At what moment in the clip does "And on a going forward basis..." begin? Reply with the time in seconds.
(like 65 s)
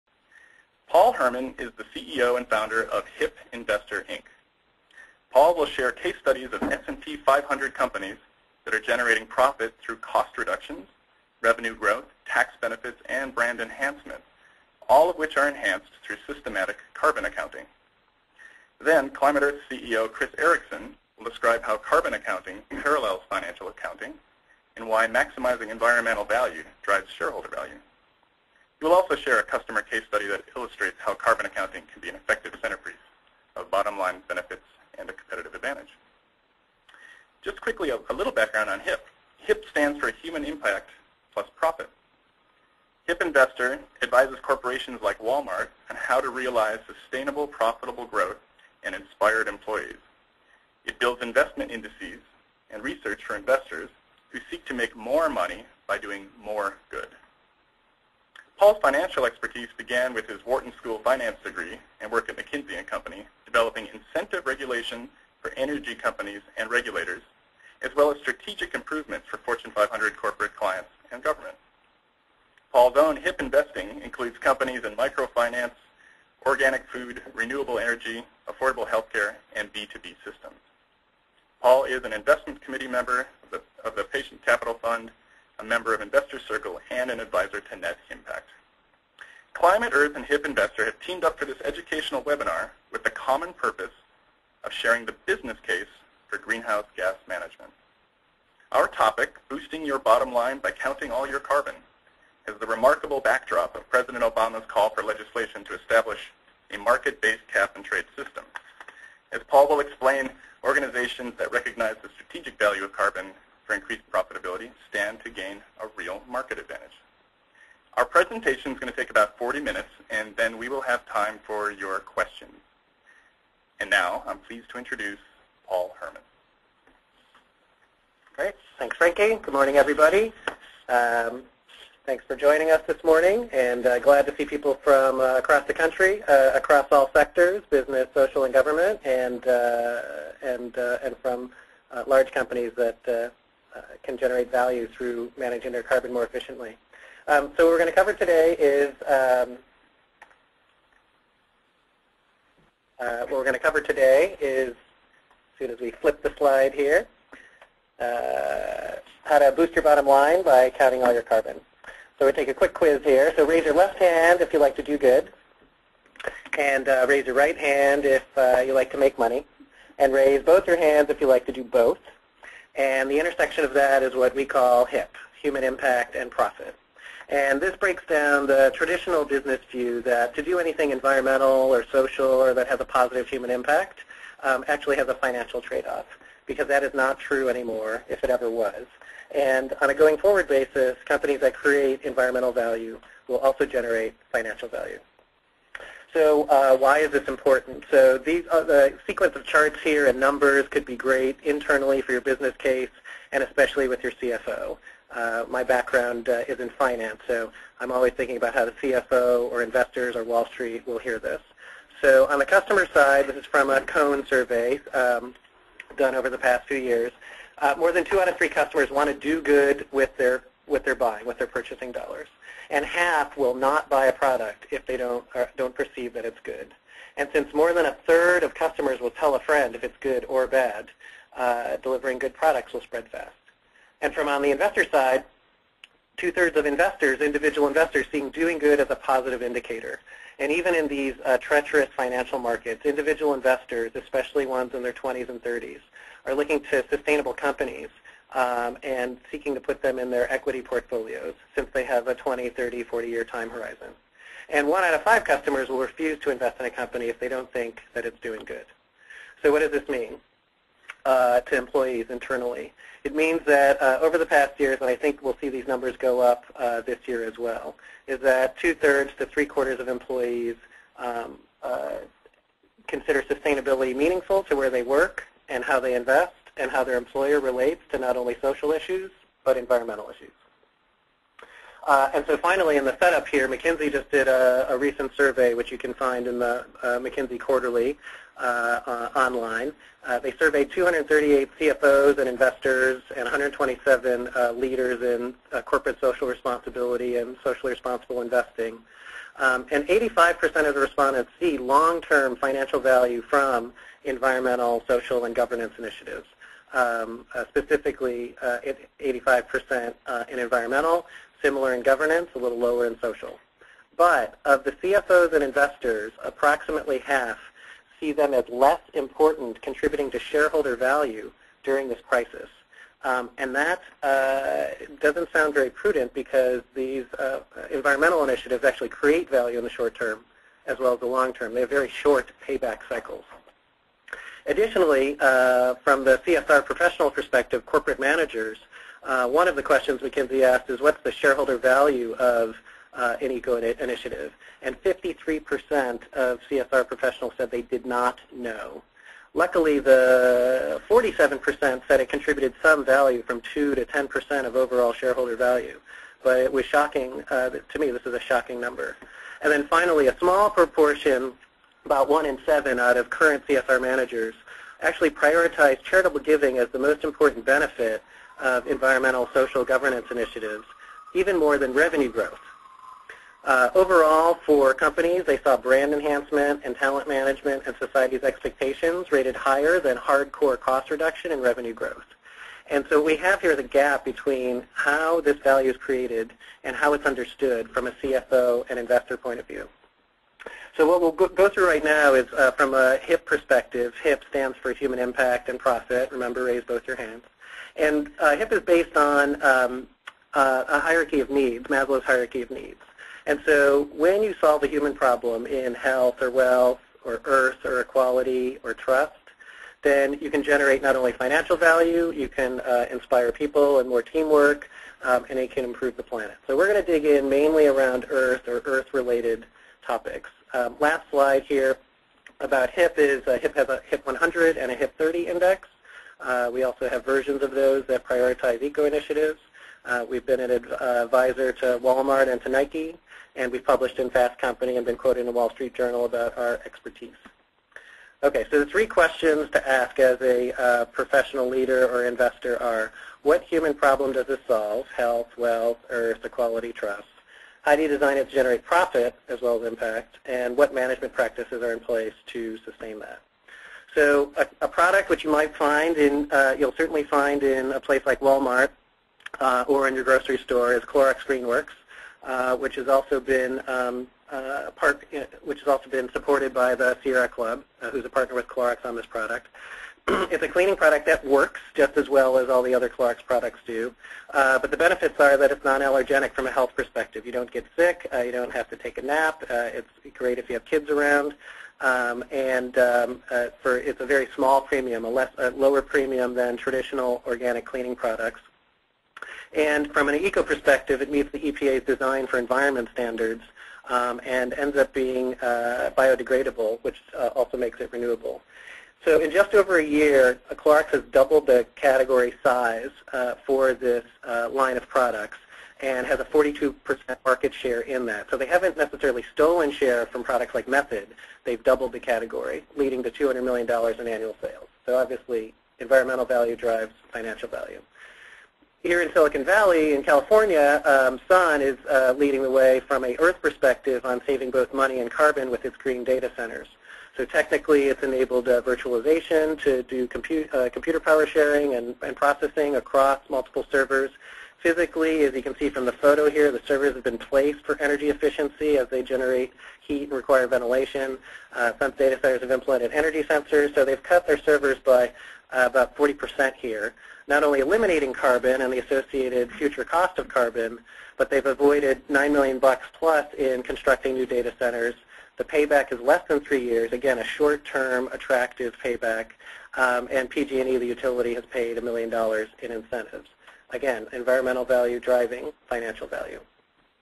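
189 s.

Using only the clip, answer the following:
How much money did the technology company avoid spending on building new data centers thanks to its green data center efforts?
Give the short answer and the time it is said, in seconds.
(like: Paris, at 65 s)
$9 million, at 552 s.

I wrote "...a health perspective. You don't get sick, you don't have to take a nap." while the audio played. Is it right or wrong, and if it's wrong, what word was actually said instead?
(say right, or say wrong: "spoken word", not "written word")
right.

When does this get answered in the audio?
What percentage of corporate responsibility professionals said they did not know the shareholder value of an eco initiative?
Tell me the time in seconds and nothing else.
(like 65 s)
344 s.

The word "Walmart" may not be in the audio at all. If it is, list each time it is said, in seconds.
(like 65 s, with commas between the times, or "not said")
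45 s, 431 s, 458 s.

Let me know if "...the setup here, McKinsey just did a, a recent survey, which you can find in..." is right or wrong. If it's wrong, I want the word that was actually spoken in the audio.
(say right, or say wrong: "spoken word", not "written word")
right.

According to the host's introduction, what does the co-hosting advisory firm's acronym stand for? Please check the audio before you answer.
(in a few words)
Human Impact Plus Profit.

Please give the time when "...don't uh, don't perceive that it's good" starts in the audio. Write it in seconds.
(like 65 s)
224 s.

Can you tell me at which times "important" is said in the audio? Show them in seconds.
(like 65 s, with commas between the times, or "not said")
197 s, 318 s, 367 s.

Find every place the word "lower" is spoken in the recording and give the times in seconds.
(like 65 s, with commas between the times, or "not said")
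312 s, 485 s.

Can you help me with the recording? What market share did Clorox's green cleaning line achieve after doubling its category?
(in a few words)
42%.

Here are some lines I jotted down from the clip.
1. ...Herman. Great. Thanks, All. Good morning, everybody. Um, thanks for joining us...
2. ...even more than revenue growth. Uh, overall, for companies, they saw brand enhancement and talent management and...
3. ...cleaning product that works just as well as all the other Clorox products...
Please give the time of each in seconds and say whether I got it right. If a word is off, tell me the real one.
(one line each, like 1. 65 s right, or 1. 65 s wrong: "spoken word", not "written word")
1. 125 s wrong: "Frankie", not "All"
2. 371 s right
3. 470 s right.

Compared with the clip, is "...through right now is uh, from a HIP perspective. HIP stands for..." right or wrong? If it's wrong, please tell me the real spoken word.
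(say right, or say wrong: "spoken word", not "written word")
right.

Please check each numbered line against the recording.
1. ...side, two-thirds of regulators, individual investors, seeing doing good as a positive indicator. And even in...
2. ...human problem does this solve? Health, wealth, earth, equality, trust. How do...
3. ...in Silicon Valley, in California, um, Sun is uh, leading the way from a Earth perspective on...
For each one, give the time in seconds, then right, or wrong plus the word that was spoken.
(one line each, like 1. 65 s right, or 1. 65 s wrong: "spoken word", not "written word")
1. 234 s wrong: "investors", not "regulators"
2. 443 s right
3. 519 s right.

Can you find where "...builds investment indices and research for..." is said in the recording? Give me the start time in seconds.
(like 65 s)
50 s.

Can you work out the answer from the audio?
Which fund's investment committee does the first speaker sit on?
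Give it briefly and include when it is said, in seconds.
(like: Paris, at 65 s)
Patient Capital Fund, at 84 s.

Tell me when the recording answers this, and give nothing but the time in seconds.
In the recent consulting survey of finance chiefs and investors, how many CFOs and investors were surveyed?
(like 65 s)
290 s.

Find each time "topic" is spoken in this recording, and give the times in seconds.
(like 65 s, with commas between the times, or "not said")
98 s, 419 s.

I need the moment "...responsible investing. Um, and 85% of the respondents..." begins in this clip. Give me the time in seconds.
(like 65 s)
297 s.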